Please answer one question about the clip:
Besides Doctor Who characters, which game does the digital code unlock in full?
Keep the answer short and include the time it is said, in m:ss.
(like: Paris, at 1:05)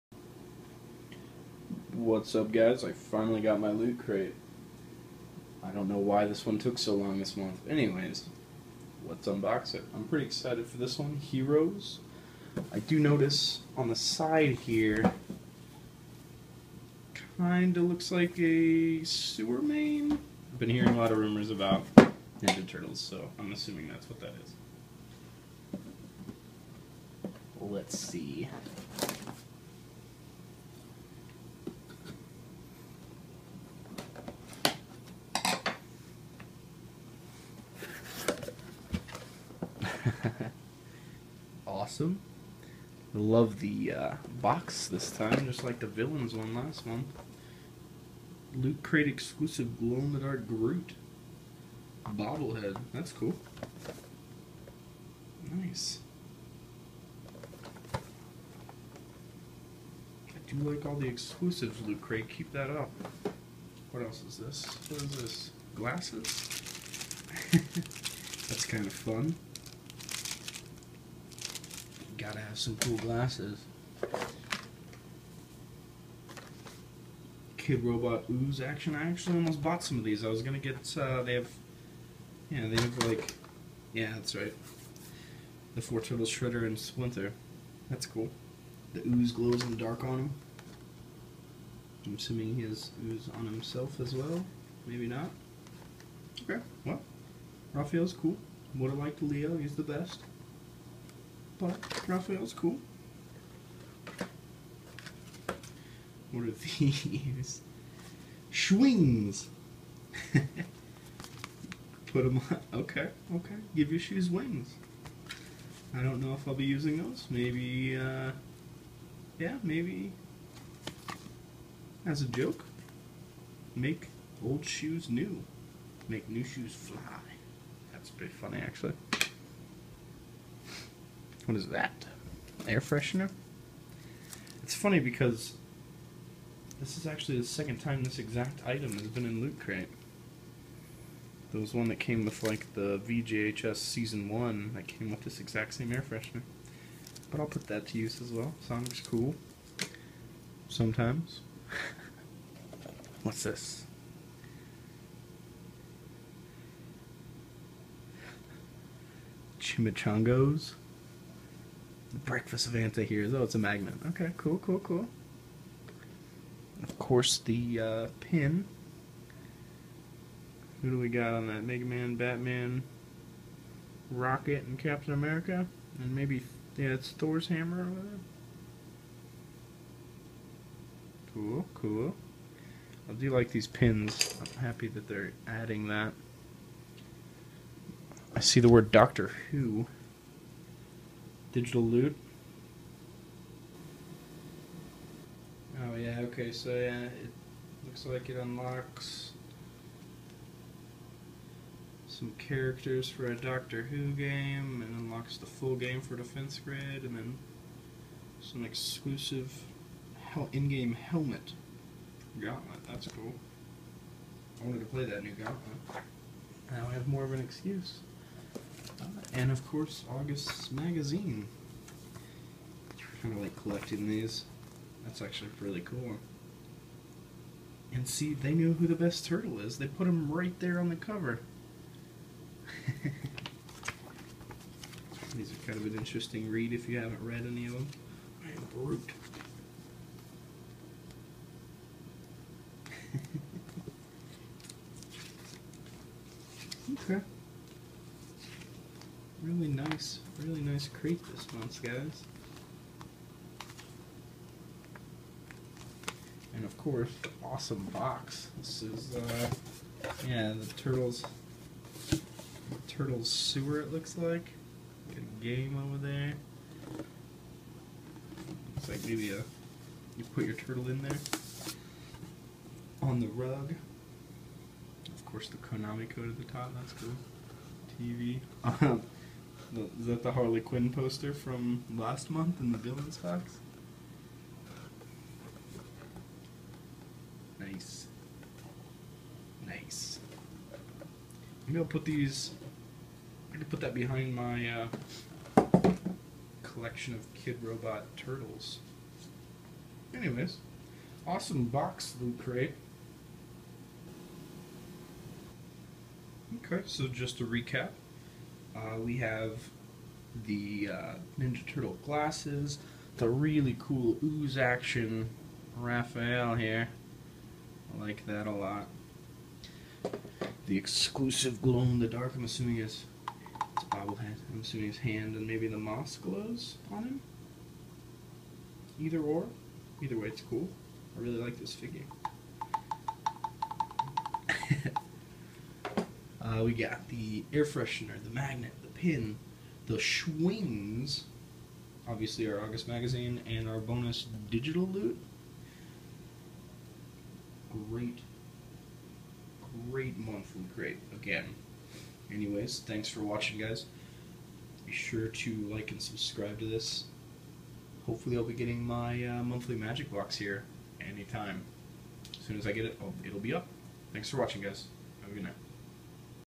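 Defense Grid, at 3:26.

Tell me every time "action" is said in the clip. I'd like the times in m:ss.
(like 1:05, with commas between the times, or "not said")
1:18, 5:14.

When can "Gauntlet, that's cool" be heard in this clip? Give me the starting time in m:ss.
3:32.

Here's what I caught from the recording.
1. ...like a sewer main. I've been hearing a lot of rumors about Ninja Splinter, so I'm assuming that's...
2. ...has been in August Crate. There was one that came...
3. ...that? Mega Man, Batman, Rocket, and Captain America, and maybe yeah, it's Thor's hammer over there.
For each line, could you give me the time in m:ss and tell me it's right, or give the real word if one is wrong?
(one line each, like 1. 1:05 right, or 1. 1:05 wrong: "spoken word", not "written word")
1. 0:18 wrong: "Turtles", not "Splinter"
2. 2:18 wrong: "Loot", not "August"
3. 2:51 right.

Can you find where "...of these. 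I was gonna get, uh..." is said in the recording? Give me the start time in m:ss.
1:19.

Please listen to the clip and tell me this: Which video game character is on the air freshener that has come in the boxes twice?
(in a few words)
Sonic.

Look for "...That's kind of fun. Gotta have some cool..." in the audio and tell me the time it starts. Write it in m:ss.
1:08.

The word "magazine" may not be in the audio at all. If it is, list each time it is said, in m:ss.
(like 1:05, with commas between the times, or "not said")
3:40, 5:42.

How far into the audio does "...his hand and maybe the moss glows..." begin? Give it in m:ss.
5:24.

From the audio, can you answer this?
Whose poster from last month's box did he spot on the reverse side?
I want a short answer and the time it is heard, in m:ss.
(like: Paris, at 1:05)
Harley Quinn, at 4:40.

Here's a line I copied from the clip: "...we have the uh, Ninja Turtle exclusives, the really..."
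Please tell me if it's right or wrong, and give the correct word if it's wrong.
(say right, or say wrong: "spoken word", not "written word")
wrong: "glasses", not "exclusives".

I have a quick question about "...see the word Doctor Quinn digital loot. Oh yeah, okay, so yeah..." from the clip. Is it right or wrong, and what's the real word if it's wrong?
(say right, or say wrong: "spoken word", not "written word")
wrong: "Who", not "Quinn".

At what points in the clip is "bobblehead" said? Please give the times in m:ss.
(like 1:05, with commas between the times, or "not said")
0:52, 5:23.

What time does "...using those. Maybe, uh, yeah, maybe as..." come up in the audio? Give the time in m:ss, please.
1:56.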